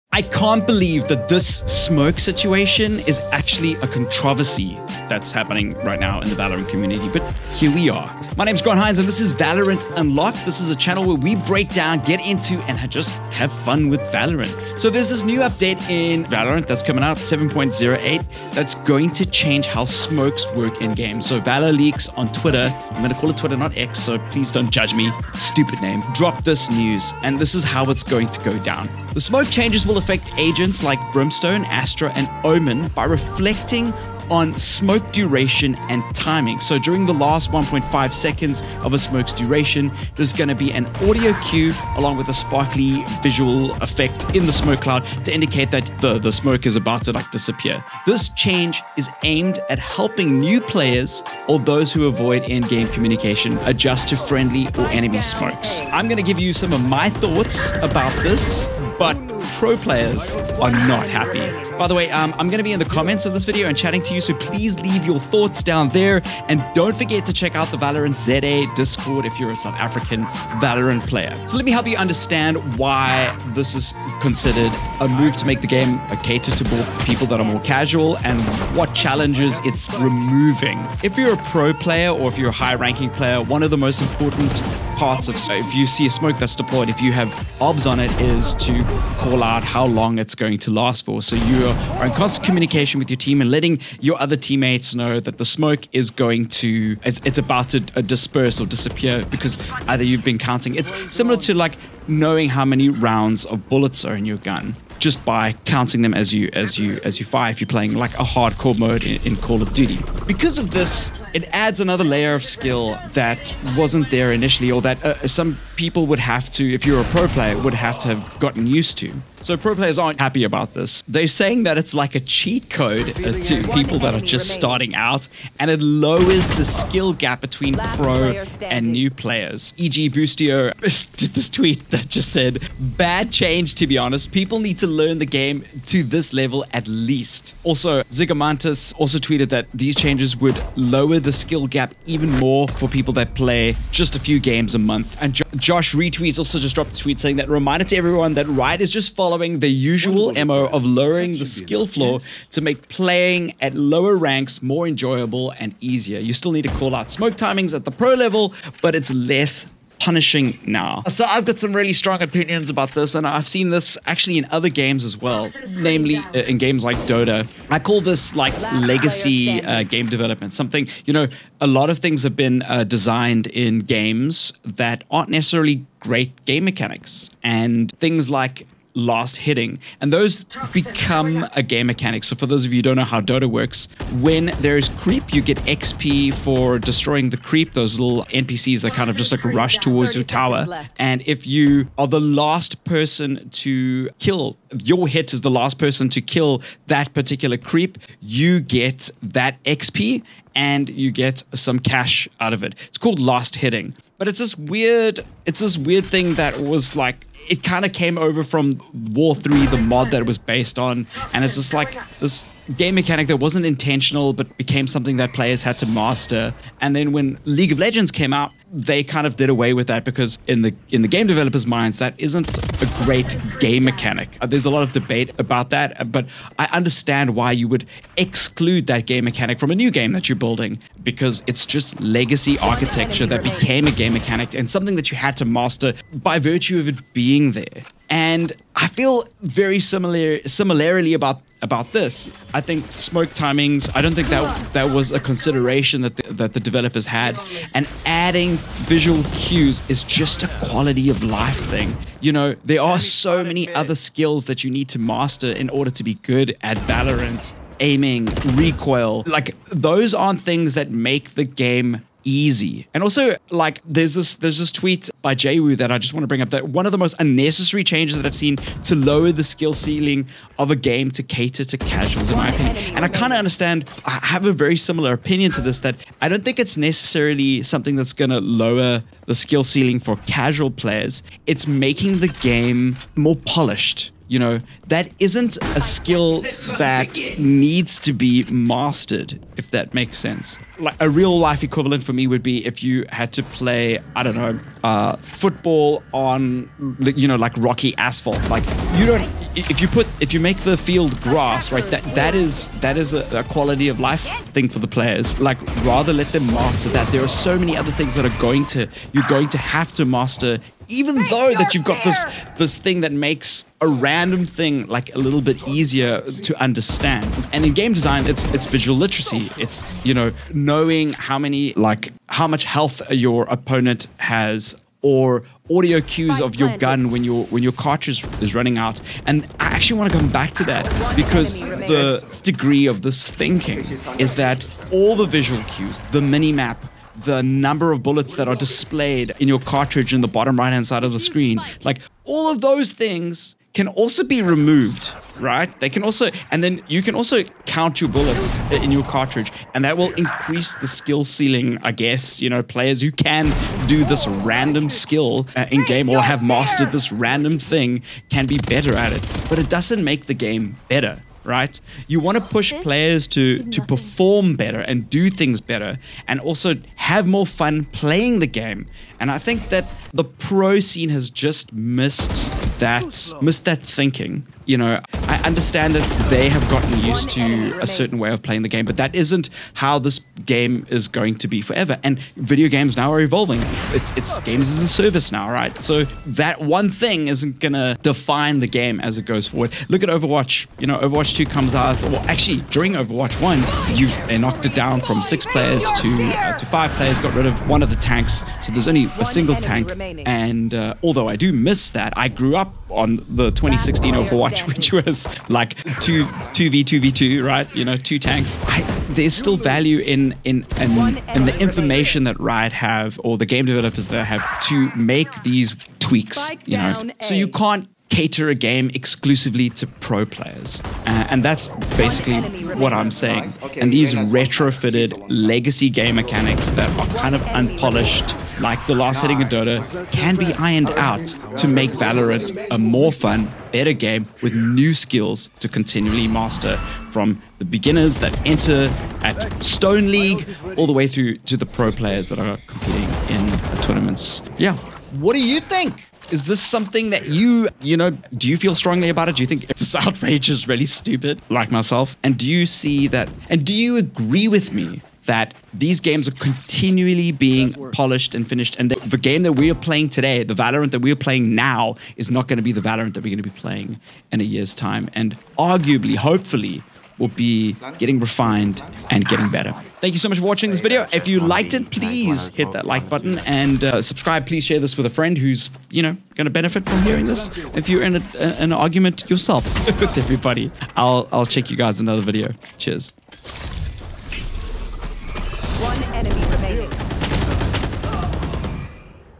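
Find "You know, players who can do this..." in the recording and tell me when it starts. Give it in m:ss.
5:52.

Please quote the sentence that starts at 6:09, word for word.
And I think that the pro scene has just missed that, miss that thinking.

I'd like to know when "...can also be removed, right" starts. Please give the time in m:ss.
5:43.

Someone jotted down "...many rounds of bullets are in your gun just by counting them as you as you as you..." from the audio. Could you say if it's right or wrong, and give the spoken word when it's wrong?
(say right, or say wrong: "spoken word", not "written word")
right.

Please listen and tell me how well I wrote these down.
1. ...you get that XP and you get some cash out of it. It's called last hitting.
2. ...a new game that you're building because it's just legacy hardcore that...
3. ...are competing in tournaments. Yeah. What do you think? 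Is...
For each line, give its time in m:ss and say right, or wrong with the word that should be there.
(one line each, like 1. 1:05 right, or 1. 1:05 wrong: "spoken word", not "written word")
1. 3:18 right
2. 3:49 wrong: "architecture", not "hardcore"
3. 7:22 right.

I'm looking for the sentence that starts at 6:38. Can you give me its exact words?
So there's only a single tank.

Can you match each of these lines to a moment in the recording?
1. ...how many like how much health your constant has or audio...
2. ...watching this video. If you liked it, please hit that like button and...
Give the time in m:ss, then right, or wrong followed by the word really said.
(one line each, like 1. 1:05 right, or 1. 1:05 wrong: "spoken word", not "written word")
1. 5:21 wrong: "opponent", not "constant"
2. 7:50 right.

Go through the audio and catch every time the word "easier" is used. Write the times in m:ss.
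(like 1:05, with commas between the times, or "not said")
2:35, 5:15.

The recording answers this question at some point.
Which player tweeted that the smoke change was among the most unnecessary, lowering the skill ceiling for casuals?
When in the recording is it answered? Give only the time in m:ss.
4:25.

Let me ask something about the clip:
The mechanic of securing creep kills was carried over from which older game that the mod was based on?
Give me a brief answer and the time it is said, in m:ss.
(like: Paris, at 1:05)
War 3, at 3:29.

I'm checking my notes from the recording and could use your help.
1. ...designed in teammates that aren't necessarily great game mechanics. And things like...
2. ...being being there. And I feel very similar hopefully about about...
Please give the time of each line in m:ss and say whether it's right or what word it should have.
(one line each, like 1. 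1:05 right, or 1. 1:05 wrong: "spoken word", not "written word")
1. 2:52 wrong: "games", not "teammates"
2. 3:57 wrong: "similarly", not "hopefully".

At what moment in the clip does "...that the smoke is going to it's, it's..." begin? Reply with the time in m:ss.
1:35.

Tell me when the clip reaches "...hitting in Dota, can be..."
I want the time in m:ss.
7:09.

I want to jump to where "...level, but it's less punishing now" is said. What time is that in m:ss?
2:38.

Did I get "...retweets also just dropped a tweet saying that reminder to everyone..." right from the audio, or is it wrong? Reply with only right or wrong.
right.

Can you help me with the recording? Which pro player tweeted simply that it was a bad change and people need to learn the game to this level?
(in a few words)
Boostio.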